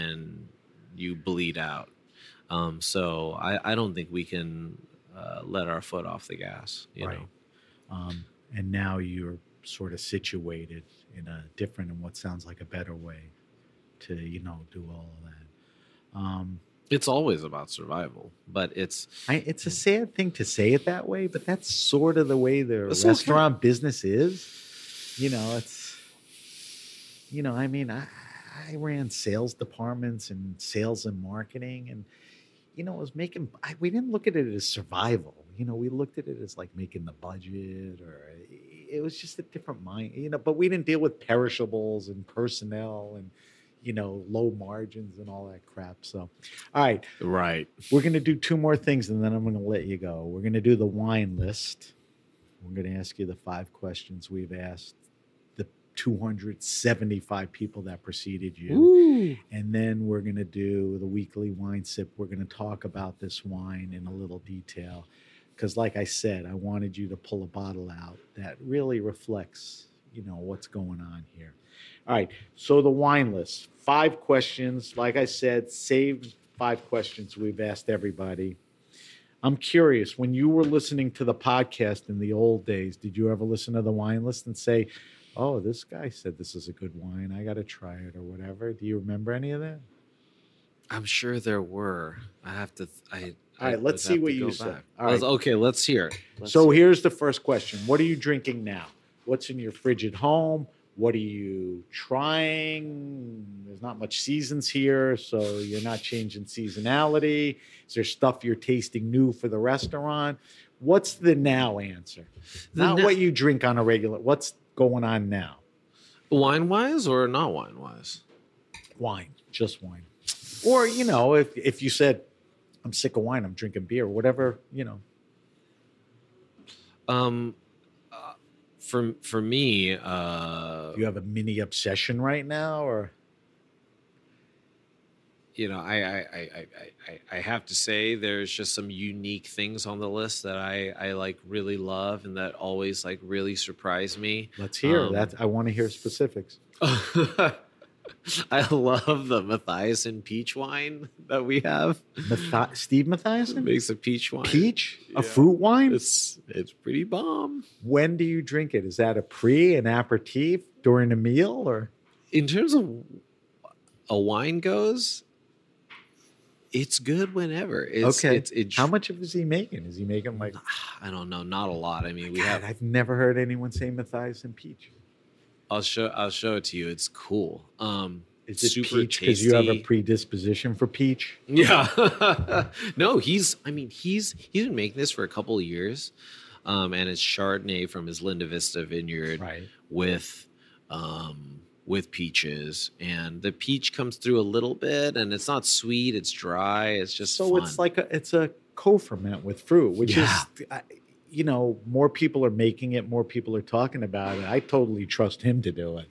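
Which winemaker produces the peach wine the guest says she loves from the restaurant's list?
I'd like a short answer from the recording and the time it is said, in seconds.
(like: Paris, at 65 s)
Steve Matthiasson, at 152 s.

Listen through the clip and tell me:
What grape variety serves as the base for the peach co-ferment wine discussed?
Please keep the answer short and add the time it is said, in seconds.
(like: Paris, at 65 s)
Chardonnay, at 187 s.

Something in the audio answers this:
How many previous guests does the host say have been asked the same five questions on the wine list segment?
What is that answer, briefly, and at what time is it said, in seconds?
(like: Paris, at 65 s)
275, at 55 s.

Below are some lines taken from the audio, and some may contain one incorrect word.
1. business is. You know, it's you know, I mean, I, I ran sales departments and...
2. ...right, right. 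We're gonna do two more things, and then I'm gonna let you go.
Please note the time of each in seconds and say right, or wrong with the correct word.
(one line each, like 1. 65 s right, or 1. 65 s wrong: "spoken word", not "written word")
1. 23 s right
2. 46 s right.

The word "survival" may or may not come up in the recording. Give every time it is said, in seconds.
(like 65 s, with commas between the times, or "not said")
17 s, 34 s.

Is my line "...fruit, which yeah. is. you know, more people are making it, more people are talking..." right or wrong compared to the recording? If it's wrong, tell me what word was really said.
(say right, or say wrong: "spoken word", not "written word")
right.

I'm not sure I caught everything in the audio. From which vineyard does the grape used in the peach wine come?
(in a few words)
Linda Vista.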